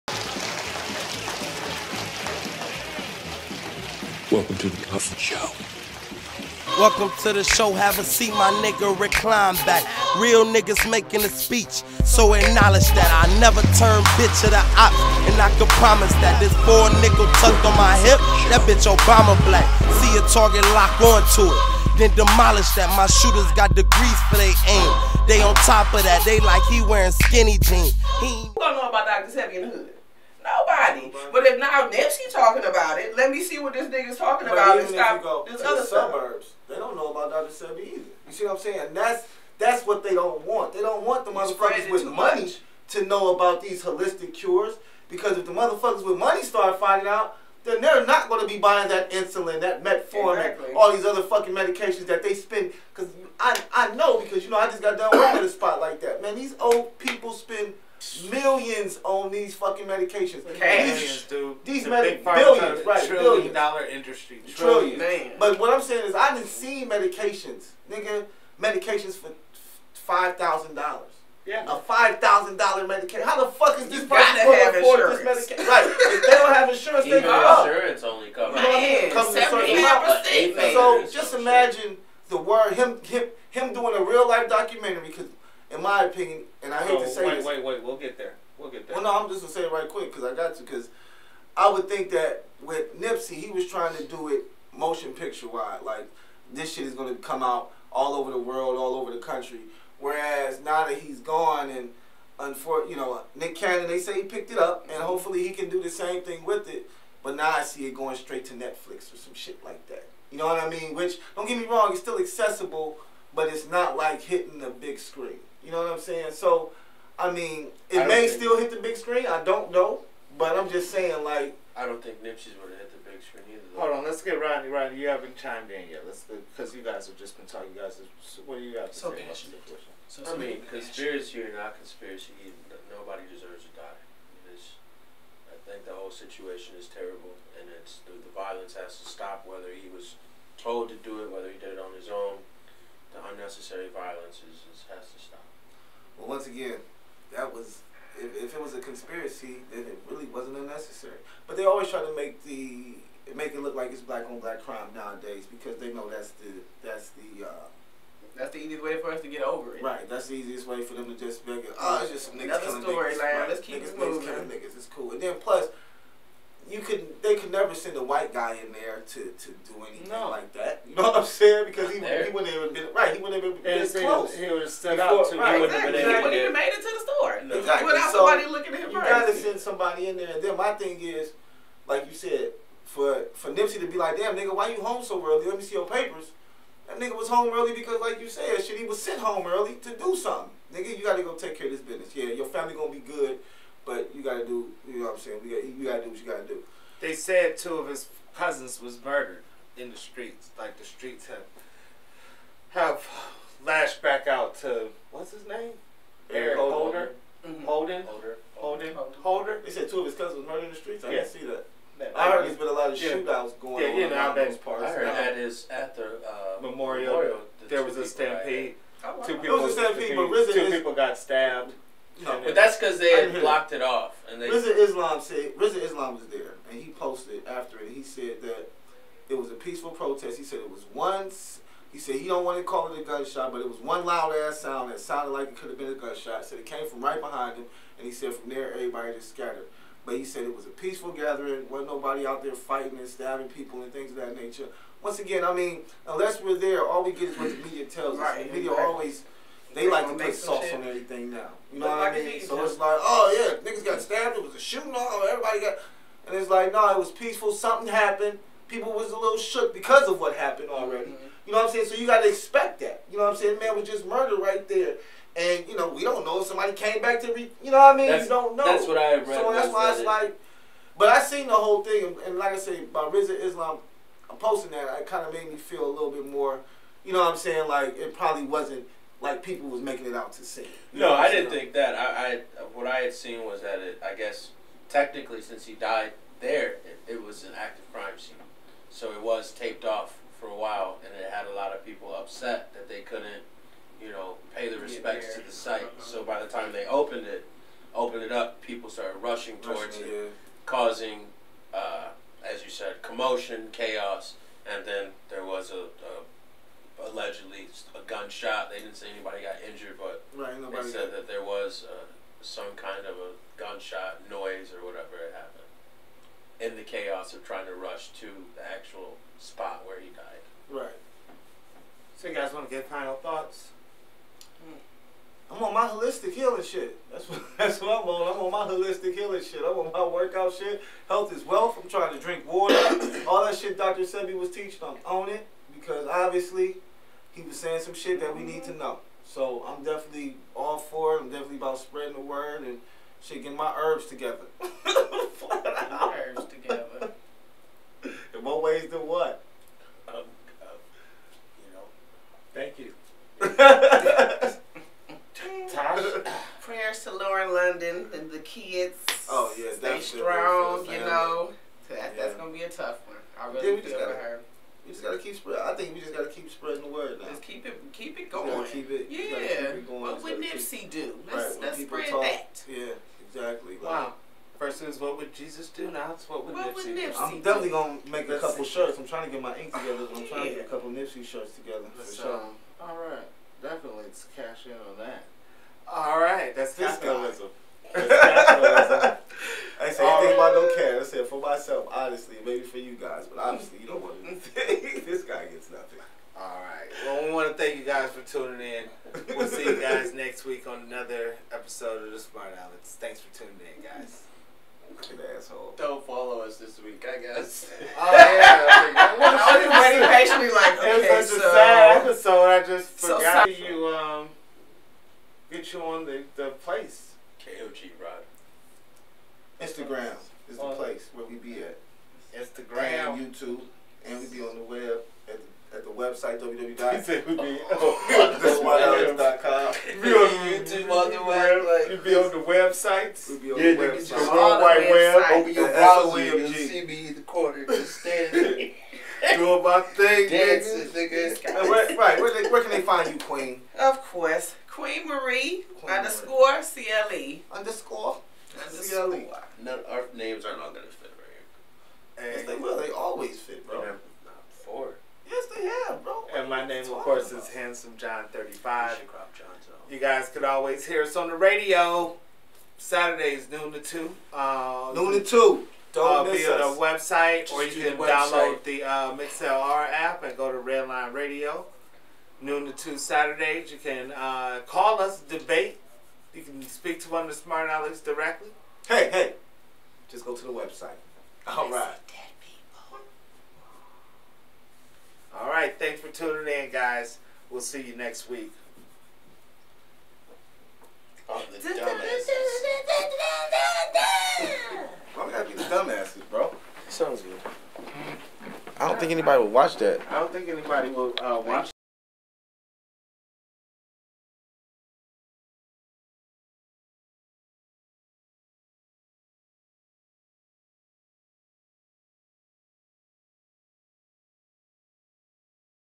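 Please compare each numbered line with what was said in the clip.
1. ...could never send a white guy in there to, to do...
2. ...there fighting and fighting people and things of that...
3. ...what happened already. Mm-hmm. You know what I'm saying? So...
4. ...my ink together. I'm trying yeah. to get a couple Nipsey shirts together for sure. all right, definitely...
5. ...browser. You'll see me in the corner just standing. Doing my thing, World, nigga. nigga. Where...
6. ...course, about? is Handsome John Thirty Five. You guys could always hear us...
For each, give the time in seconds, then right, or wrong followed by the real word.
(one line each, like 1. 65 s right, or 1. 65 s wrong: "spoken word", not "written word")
1. 167 s right
2. 242 s wrong: "stabbing", not "fighting"
3. 260 s right
4. 379 s right
5. 435 s wrong: "Dancing", not "World"
6. 456 s right.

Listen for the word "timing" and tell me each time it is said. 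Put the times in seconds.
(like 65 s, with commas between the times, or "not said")
not said.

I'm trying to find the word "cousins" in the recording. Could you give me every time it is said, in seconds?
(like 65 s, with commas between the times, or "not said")
198 s, 210 s.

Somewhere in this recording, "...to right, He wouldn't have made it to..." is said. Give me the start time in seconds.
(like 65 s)
175 s.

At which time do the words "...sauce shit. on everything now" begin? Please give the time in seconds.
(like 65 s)
250 s.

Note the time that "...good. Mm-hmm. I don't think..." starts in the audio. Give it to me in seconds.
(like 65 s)
497 s.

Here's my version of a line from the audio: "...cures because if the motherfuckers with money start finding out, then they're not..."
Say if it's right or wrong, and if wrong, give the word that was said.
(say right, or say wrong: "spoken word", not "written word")
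right.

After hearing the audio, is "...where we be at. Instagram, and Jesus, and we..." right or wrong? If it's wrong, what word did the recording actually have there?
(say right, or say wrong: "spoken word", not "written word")
wrong: "YouTube", not "Jesus".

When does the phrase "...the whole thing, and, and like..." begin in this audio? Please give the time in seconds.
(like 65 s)
271 s.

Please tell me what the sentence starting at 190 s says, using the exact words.
Nigga, you gotta go take care of this business.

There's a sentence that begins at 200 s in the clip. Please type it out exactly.
Like the streets have have lashed back out to what's his name?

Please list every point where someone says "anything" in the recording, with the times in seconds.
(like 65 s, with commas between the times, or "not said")
169 s, 394 s.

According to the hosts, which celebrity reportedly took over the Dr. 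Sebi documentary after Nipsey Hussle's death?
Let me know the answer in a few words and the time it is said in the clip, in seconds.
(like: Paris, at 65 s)
Nick Cannon, at 103 s.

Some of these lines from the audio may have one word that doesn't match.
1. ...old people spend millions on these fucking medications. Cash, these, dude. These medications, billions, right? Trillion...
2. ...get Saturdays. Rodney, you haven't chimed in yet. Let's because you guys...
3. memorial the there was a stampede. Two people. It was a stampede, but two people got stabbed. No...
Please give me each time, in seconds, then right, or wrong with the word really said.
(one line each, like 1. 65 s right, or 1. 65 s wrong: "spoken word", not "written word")
1. 56 s right
2. 124 s wrong: "Rodney", not "Saturdays"
3. 217 s right.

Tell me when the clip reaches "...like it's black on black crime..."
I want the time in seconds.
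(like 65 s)
153 s.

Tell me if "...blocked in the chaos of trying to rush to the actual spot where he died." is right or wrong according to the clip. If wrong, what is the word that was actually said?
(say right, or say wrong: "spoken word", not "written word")
wrong: "happened", not "blocked".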